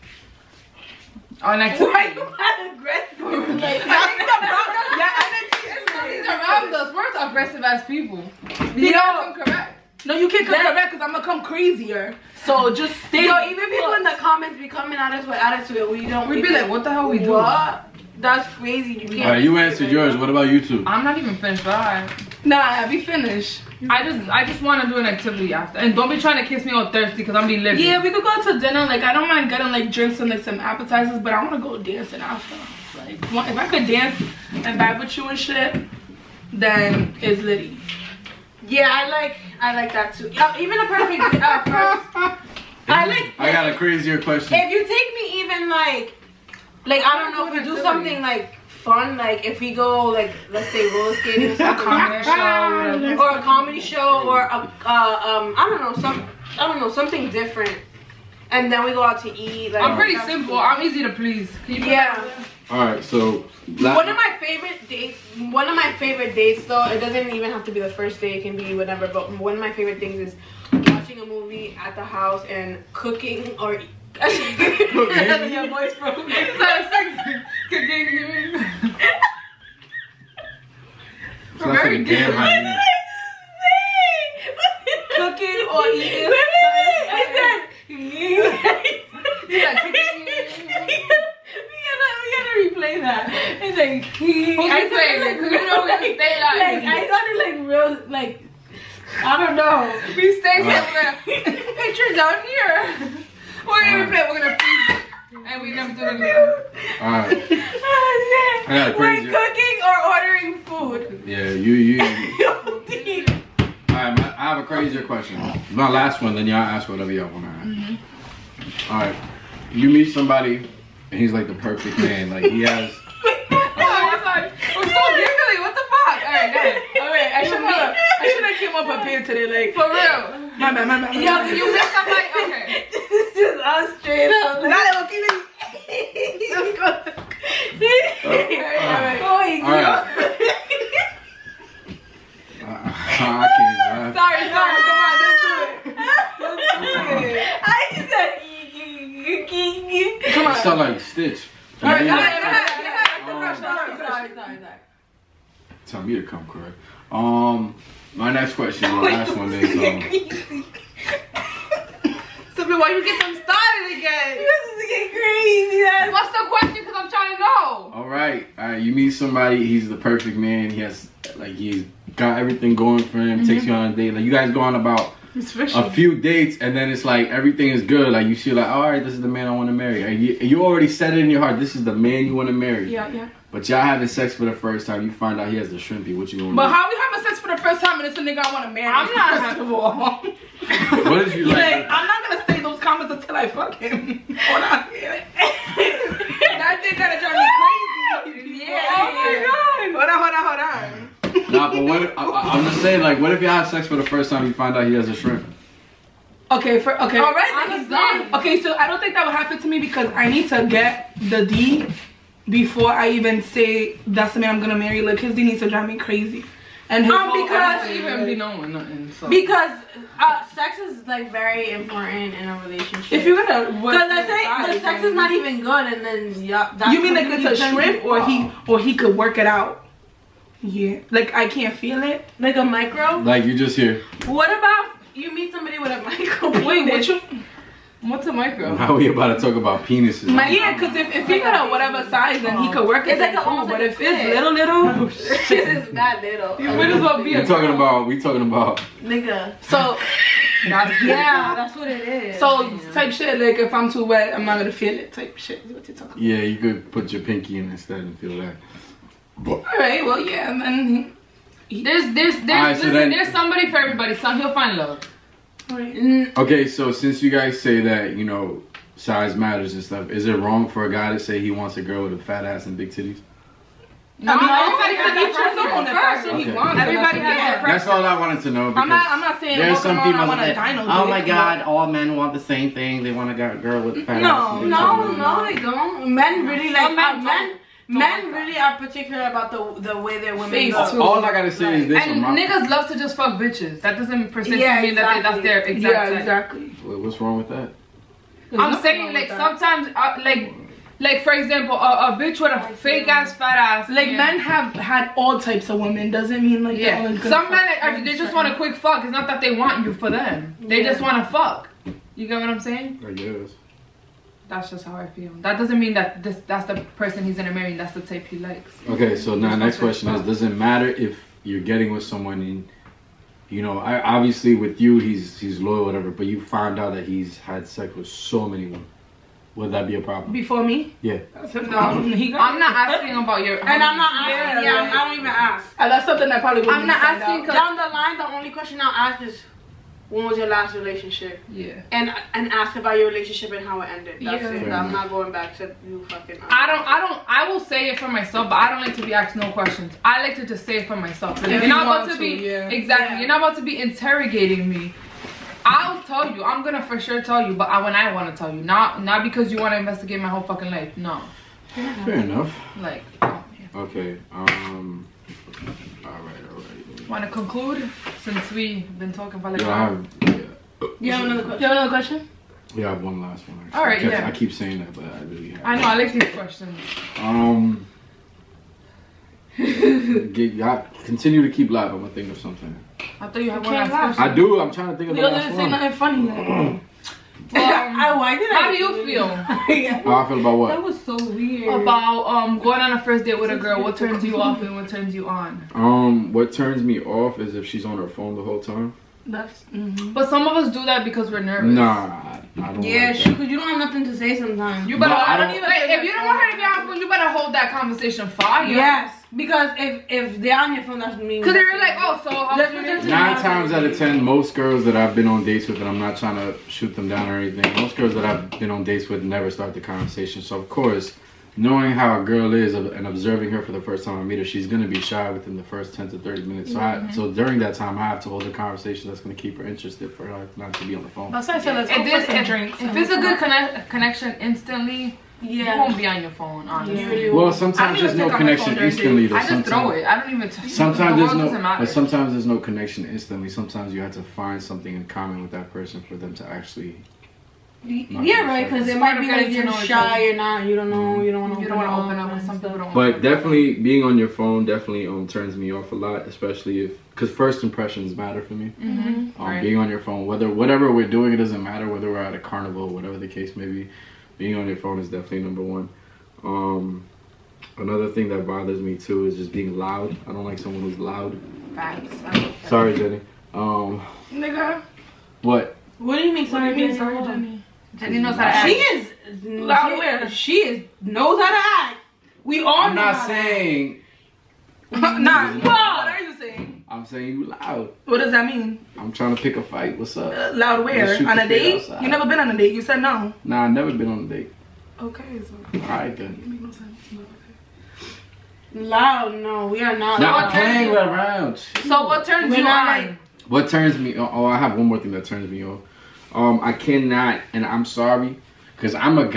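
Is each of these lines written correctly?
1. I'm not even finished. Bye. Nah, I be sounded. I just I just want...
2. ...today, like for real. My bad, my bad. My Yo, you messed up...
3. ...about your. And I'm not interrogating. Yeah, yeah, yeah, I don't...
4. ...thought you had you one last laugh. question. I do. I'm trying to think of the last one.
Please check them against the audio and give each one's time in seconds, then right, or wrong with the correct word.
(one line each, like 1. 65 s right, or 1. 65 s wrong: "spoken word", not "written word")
1. 20 s wrong: "finished", not "sounded"
2. 129 s right
3. 333 s wrong: "asking", not "interrogating"
4. 383 s right.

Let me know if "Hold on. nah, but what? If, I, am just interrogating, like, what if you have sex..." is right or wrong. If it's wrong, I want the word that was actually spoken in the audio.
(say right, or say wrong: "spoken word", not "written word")
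wrong: "saying", not "interrogating".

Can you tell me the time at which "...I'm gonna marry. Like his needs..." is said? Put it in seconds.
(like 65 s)
214 s.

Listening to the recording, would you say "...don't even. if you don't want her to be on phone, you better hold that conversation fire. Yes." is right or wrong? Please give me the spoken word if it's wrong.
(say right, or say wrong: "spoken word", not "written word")
right.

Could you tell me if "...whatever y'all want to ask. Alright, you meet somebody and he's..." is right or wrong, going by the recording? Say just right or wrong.
right.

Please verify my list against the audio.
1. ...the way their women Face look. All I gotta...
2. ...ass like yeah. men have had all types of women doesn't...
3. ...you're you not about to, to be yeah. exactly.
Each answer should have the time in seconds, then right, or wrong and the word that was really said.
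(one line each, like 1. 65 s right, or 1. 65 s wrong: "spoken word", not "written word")
1. 289 s right
2. 303 s right
3. 351 s right.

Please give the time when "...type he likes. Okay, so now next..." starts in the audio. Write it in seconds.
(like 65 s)
318 s.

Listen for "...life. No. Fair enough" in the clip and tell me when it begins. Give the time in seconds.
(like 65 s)
360 s.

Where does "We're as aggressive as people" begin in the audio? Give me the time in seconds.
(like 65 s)
6 s.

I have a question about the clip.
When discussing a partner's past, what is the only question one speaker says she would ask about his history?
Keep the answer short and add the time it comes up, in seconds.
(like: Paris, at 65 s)
When was your last relationship, at 340 s.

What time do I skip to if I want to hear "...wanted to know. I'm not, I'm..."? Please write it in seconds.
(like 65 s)
278 s.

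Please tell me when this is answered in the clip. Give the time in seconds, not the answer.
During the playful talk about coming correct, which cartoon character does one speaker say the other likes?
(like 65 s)
151 s.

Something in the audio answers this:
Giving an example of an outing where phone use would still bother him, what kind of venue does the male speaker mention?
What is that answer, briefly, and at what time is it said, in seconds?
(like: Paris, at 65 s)
A carnival, at 462 s.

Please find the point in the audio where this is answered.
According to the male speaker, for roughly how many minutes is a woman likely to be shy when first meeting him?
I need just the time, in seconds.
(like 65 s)
425 s.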